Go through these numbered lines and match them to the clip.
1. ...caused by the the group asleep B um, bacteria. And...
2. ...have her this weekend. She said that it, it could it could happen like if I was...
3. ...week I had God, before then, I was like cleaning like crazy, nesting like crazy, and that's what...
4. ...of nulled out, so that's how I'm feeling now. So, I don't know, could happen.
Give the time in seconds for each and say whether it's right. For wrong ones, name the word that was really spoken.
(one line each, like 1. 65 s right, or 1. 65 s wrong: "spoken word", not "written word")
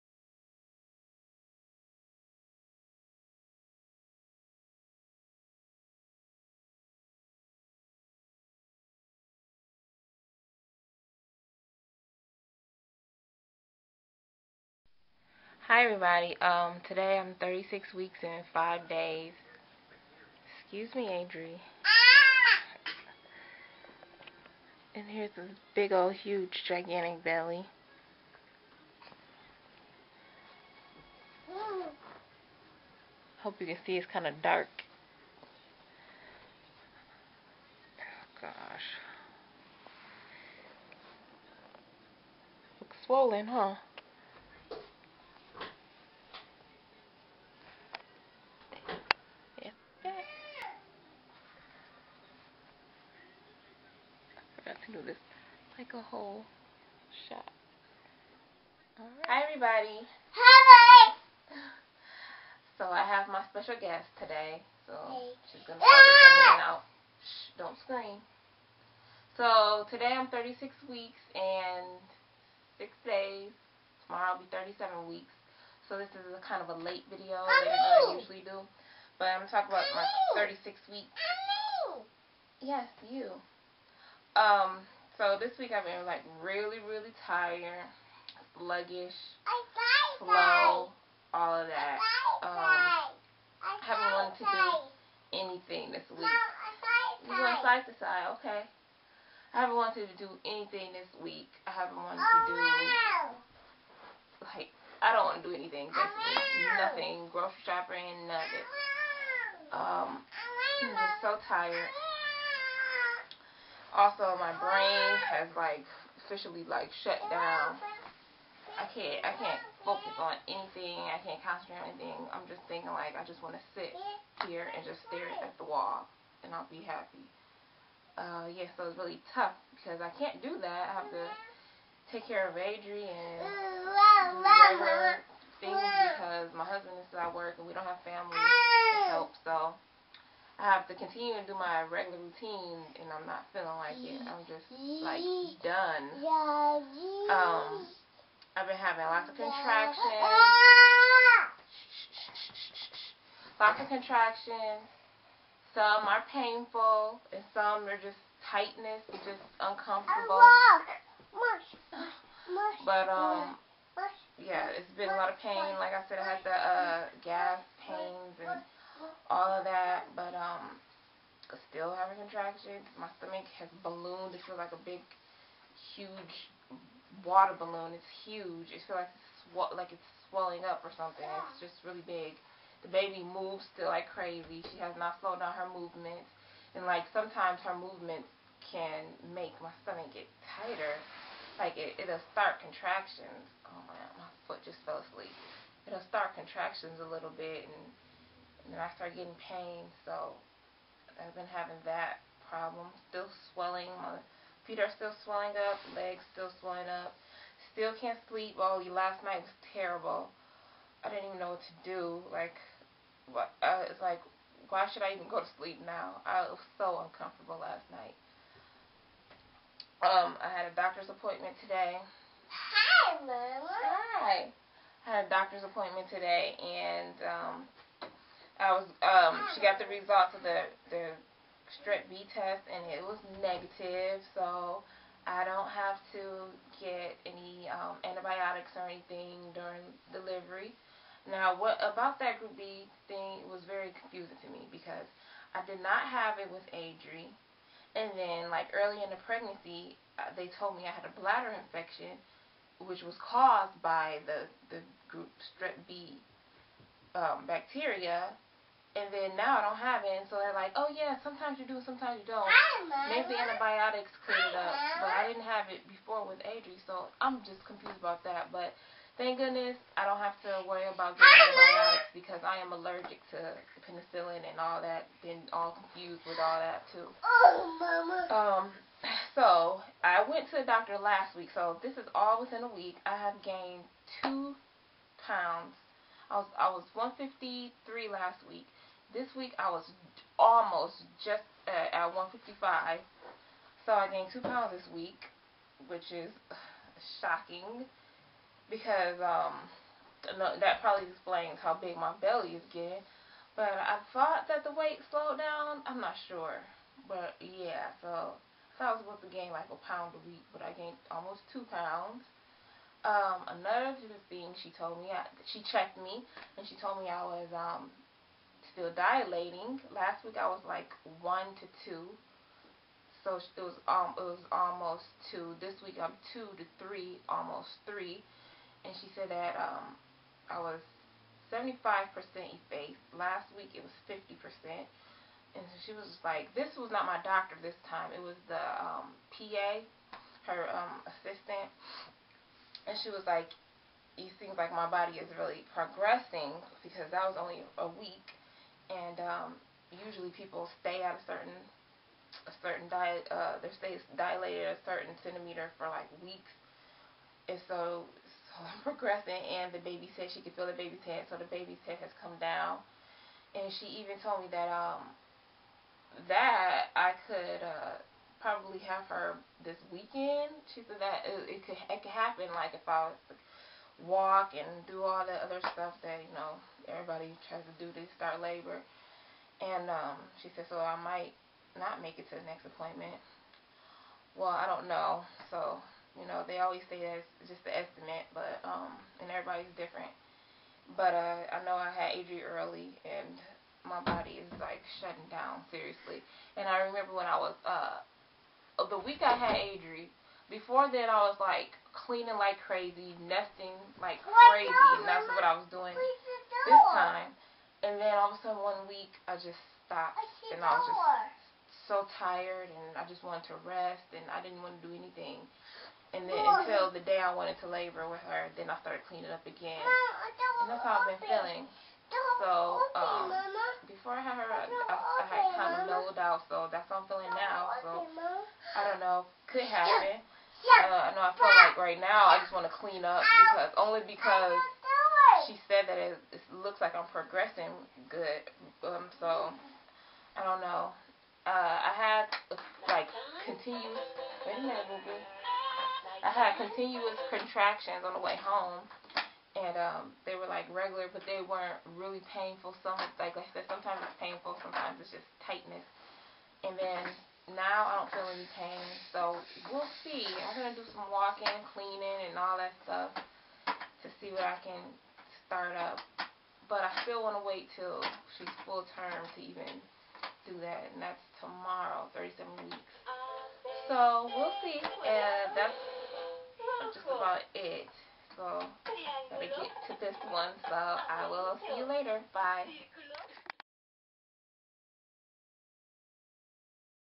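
1. 253 s wrong: "strep", not "asleep"
2. 368 s right
3. 398 s wrong: "Adri", not "God"
4. 425 s right.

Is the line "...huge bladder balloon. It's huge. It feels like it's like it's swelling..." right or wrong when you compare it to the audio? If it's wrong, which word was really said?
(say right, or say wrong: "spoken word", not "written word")
wrong: "water", not "bladder".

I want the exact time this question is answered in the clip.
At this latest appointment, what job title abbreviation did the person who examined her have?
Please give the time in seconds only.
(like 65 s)
339 s.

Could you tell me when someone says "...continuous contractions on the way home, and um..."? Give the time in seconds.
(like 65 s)
446 s.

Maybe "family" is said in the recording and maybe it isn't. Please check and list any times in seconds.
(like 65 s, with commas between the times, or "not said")
138 s.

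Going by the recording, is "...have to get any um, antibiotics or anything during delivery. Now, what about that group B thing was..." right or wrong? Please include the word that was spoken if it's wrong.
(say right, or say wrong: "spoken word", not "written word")
right.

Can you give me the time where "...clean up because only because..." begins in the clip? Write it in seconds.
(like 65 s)
432 s.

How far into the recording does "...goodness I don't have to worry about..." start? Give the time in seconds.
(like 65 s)
269 s.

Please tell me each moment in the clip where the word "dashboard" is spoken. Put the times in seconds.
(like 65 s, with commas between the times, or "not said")
not said.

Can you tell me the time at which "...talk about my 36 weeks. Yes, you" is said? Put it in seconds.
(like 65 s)
79 s.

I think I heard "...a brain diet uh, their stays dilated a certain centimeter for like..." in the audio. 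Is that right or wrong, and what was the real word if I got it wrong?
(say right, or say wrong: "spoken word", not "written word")
wrong: "certain", not "brain".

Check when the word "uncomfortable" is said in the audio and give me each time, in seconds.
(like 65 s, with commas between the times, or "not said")
159 s, 217 s.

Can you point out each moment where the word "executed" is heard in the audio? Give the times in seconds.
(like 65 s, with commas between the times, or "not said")
not said.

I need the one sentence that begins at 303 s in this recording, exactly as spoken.
But I thought that the weight slowed down.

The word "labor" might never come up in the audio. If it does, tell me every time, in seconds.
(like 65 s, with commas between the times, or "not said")
378 s, 417 s.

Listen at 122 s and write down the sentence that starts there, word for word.
I'm just thinking like I just want to sit here and just stare at the wall, and I'll be happy.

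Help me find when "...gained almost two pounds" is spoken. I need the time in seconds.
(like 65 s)
310 s.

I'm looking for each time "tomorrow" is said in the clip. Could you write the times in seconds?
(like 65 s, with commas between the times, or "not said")
74 s, 471 s.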